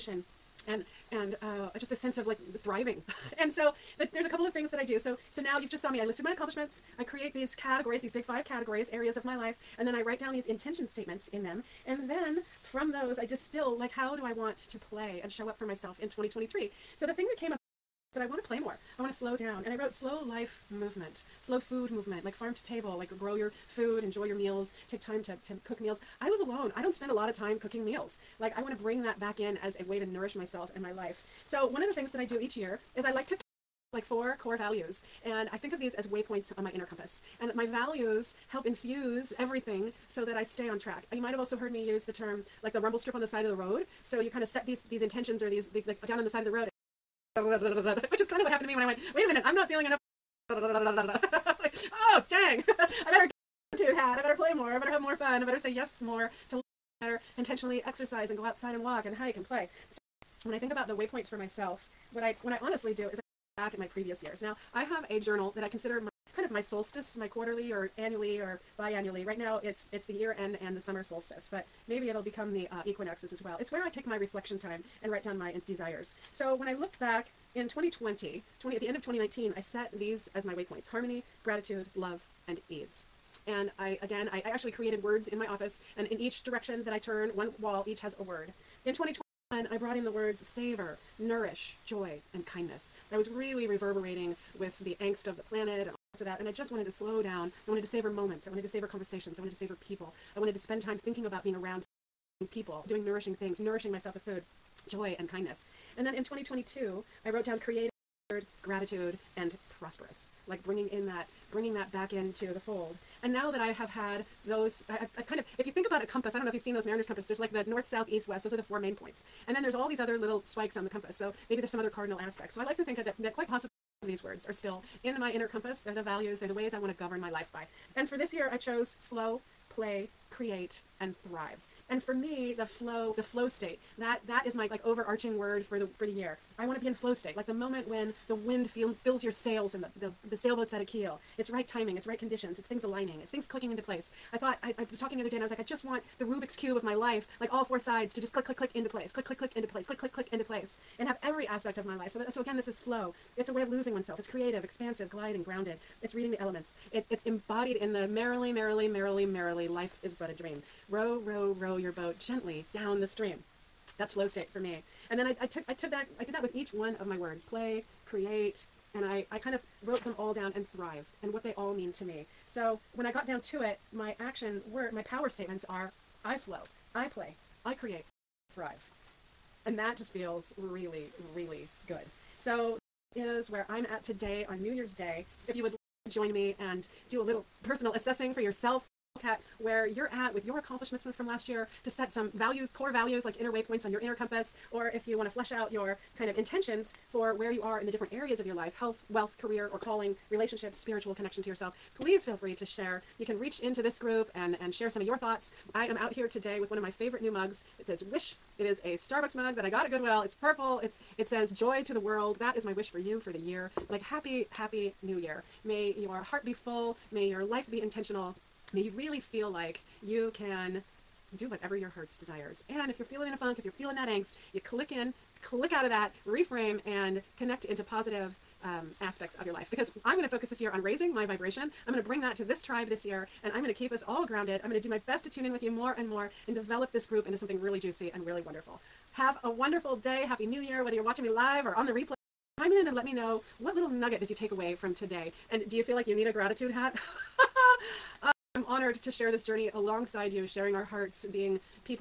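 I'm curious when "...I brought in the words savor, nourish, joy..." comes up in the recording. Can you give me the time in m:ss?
1:29.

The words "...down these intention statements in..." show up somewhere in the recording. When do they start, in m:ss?
0:10.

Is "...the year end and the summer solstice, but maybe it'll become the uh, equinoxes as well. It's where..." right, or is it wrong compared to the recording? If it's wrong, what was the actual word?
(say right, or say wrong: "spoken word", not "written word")
right.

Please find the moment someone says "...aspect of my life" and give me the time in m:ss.
2:31.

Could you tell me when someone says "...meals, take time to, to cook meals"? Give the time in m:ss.
0:24.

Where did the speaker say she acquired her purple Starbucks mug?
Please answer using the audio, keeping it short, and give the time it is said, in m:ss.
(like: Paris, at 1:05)
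Goodwill, at 3:29.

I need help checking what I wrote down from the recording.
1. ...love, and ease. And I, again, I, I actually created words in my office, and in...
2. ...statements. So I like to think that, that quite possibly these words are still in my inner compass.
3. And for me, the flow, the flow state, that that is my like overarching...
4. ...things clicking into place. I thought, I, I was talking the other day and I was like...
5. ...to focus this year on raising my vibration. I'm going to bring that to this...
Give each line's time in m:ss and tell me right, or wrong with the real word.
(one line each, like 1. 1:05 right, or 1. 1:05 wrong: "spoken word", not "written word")
1. 1:21 right
2. 2:02 wrong: "aspects", not "statements"
3. 2:11 right
4. 2:23 right
5. 3:50 right.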